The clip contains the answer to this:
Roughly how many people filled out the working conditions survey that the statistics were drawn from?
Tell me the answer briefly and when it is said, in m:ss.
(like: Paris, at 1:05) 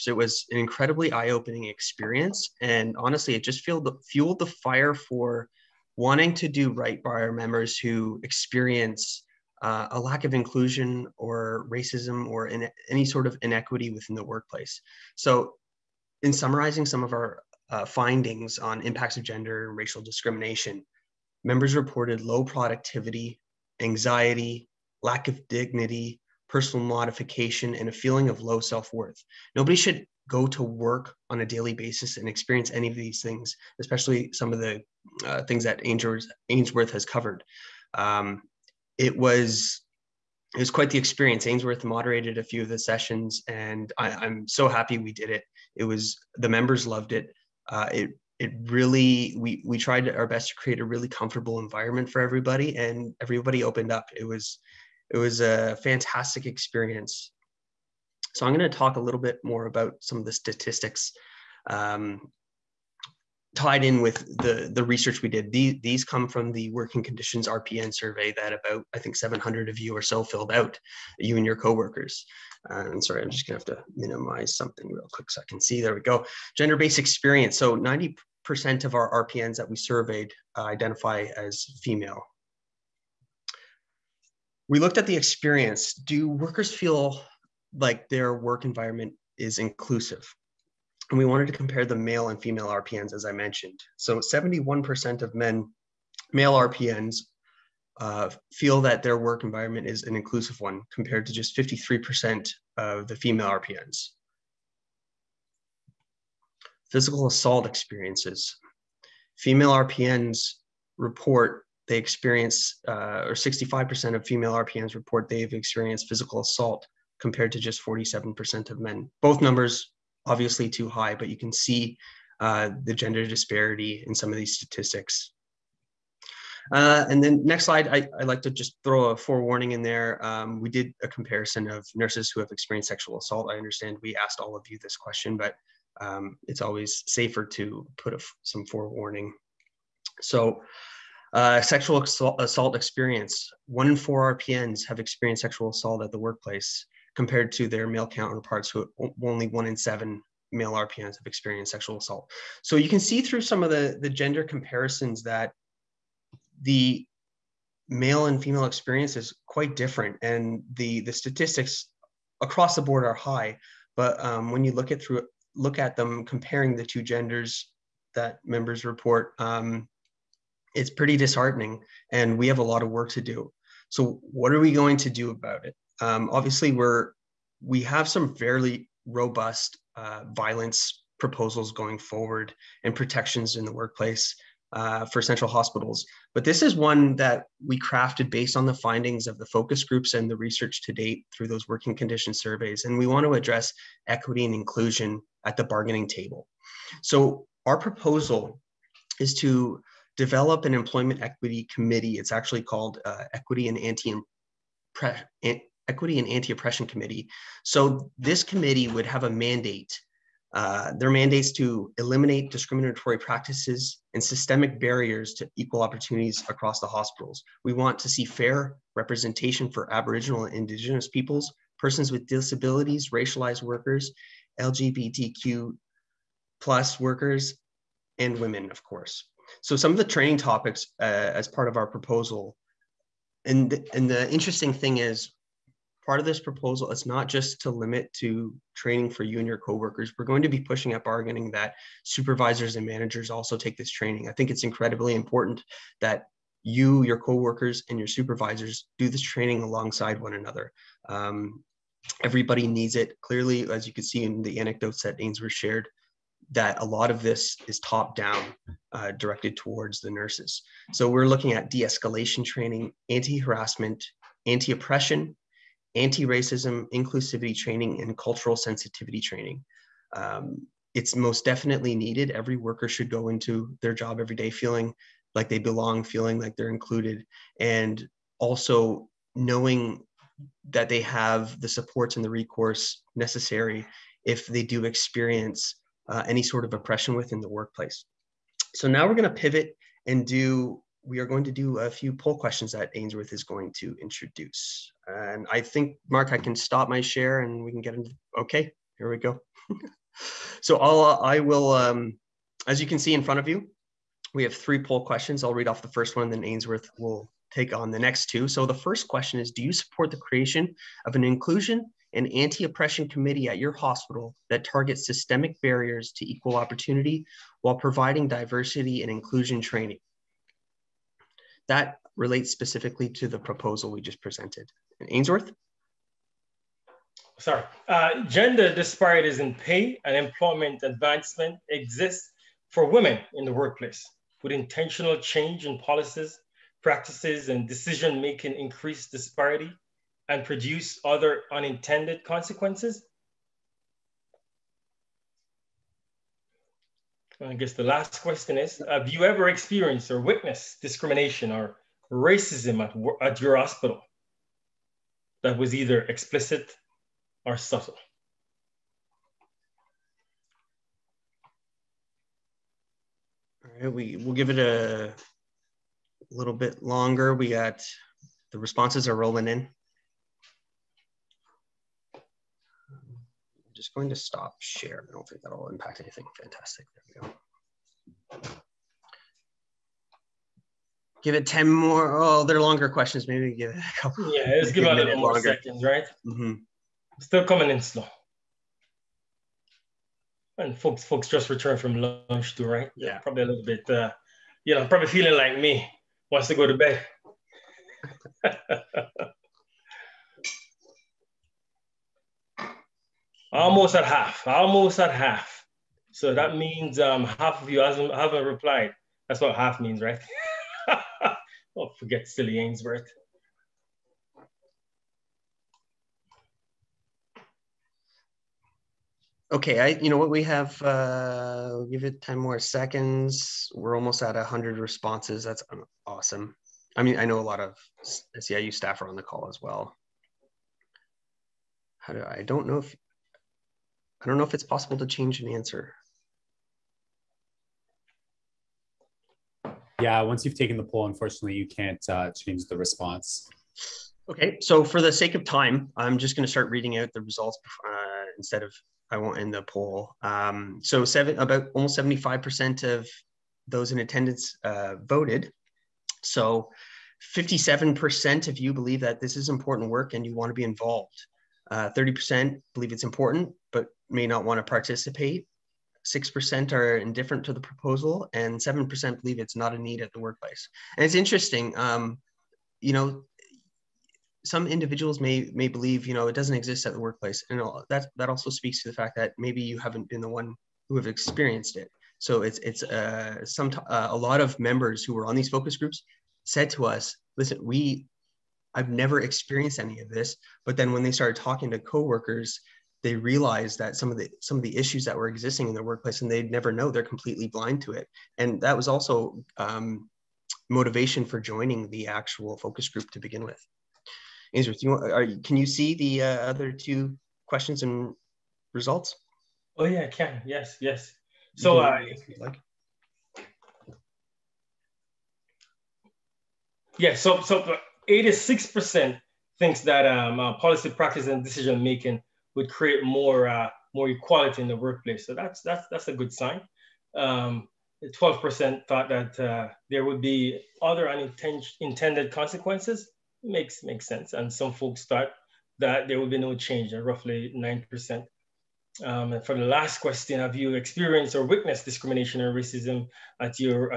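700, at 1:09.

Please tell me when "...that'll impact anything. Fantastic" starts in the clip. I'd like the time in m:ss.
6:15.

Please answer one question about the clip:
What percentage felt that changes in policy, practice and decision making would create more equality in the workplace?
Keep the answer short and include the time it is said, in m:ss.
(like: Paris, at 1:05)
86%, at 8:38.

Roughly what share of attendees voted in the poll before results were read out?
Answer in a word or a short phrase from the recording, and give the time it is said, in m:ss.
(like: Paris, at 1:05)
75%, at 7:31.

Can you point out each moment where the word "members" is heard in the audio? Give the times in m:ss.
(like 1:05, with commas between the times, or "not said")
0:07, 0:21, 0:46, 2:48, 8:04.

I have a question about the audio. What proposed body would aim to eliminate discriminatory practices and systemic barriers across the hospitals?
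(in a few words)
Equity and Anti-Oppression Committee.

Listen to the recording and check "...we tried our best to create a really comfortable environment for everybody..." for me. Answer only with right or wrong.
right.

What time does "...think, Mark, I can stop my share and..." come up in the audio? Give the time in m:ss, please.
4:55.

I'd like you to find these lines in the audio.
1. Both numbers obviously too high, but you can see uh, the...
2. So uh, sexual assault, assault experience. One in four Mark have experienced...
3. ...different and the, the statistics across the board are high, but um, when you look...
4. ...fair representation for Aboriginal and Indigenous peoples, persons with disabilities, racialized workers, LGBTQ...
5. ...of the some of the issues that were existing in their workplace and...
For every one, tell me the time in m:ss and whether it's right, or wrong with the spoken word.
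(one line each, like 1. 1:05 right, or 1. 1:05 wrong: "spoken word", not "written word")
1. 1:59 right
2. 2:20 wrong: "RPNs", not "Mark"
3. 2:39 right
4. 3:38 right
5. 8:14 right.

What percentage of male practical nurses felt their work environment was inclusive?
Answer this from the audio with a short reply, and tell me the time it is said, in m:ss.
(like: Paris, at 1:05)
71%, at 1:34.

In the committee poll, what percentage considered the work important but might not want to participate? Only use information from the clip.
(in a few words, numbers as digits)
30%.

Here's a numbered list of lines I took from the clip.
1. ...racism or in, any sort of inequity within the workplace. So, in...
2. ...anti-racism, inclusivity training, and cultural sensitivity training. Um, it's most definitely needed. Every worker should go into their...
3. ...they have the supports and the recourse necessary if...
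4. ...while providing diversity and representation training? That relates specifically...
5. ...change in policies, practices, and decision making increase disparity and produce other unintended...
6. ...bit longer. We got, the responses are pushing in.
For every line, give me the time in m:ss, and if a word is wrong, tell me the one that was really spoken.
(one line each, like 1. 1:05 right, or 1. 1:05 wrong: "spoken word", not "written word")
1. 0:11 right
2. 4:25 right
3. 4:40 right
4. 5:17 wrong: "inclusion", not "representation"
5. 5:35 right
6. 6:06 wrong: "rolling", not "pushing".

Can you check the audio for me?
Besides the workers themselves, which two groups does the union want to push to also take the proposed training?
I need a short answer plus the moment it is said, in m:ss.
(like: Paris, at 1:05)
supervisors and managers, at 4:02.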